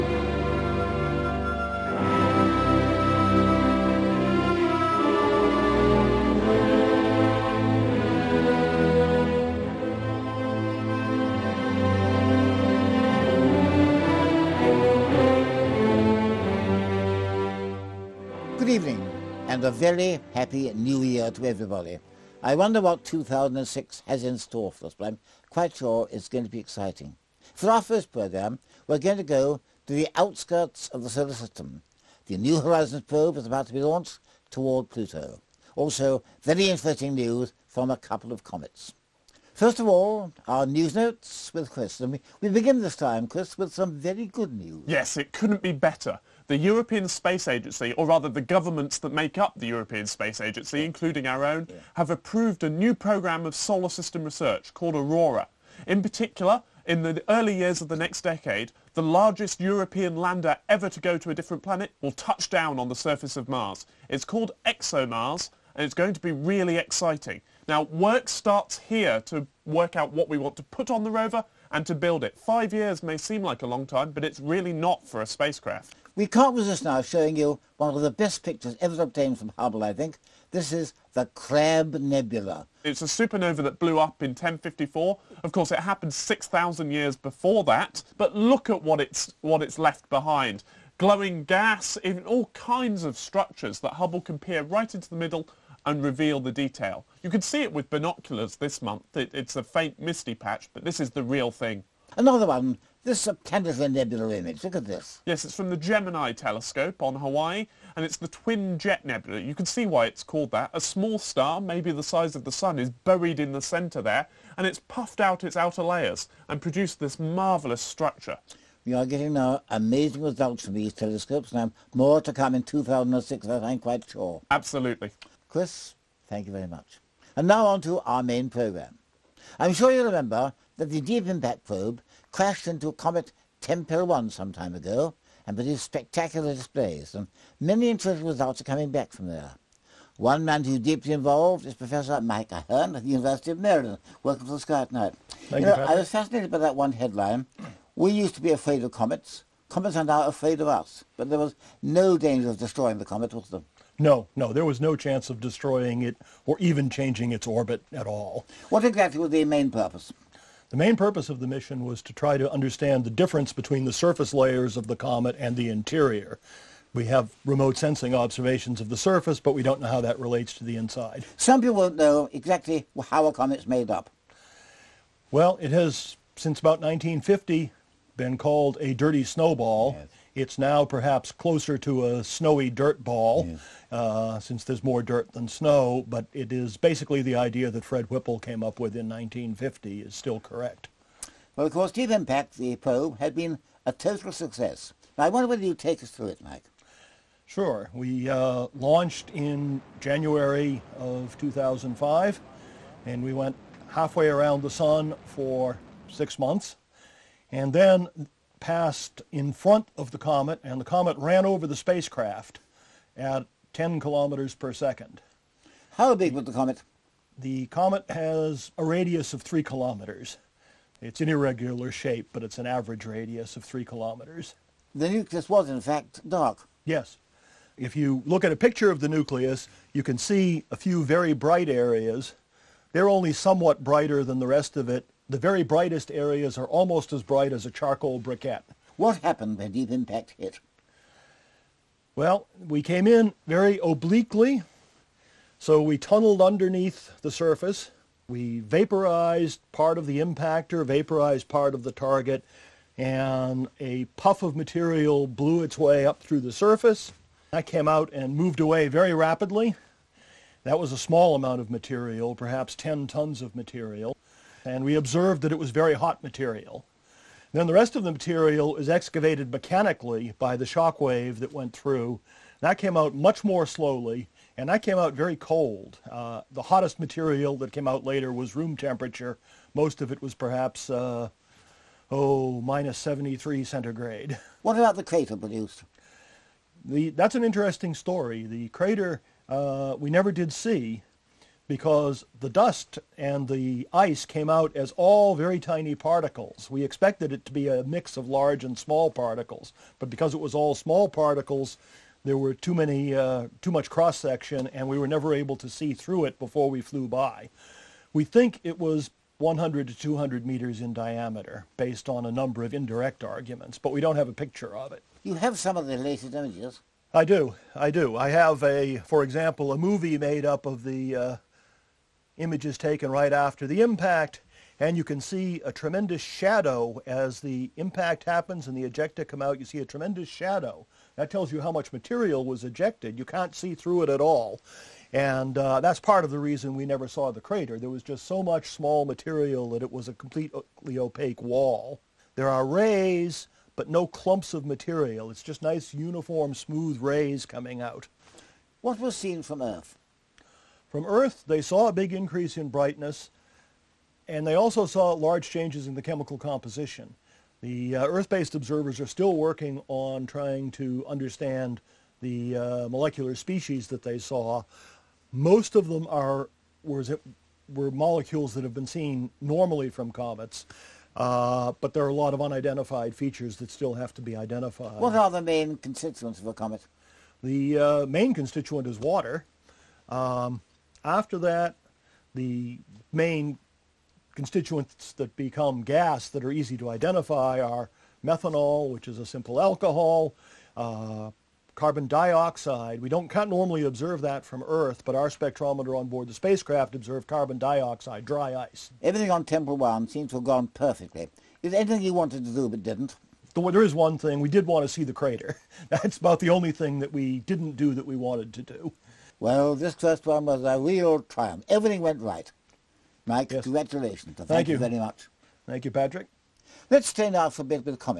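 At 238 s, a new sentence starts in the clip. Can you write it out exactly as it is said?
What happened when the impact hit?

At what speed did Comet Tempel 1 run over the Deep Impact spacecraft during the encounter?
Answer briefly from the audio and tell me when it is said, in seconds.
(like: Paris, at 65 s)
10 kilometers per second, at 213 s.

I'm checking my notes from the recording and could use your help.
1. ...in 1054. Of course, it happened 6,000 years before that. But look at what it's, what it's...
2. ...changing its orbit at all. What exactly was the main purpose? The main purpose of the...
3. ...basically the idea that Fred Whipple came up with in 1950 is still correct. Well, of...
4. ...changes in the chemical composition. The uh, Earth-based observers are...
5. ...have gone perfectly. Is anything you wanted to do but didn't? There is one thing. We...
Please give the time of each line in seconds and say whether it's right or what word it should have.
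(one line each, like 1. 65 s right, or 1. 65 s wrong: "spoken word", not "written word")
1. 84 s right
2. 156 s right
3. 186 s right
4. 355 s right
5. 400 s right.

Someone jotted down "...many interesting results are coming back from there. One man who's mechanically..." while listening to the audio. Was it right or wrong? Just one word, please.
wrong.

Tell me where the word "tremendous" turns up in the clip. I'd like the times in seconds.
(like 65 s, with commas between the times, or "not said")
325 s, 329 s.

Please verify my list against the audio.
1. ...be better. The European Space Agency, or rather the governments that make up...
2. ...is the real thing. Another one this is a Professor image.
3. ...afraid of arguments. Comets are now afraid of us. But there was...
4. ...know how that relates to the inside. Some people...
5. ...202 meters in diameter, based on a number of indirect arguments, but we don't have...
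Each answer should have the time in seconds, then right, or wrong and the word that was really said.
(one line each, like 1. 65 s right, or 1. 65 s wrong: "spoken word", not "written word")
1. 45 s right
2. 100 s wrong: "Tanager", not "Professor"
3. 148 s wrong: "comets", not "arguments"
4. 169 s right
5. 309 s wrong: "200", not "202".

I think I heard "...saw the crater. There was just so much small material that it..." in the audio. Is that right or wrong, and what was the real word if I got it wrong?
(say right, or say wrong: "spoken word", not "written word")
right.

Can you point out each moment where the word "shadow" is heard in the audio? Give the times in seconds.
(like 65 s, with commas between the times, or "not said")
326 s, 330 s.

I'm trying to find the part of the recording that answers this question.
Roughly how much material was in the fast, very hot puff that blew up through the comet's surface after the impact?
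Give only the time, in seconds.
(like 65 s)
262 s.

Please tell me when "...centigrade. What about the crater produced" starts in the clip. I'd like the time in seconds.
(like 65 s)
283 s.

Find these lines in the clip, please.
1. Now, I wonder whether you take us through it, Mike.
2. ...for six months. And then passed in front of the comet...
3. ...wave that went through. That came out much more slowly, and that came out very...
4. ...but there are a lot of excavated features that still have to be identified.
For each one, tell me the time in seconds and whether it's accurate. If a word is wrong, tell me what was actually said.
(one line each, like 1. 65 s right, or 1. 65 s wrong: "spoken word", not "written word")
1. 195 s right
2. 205 s right
3. 271 s right
4. 371 s wrong: "unidentified", not "excavated".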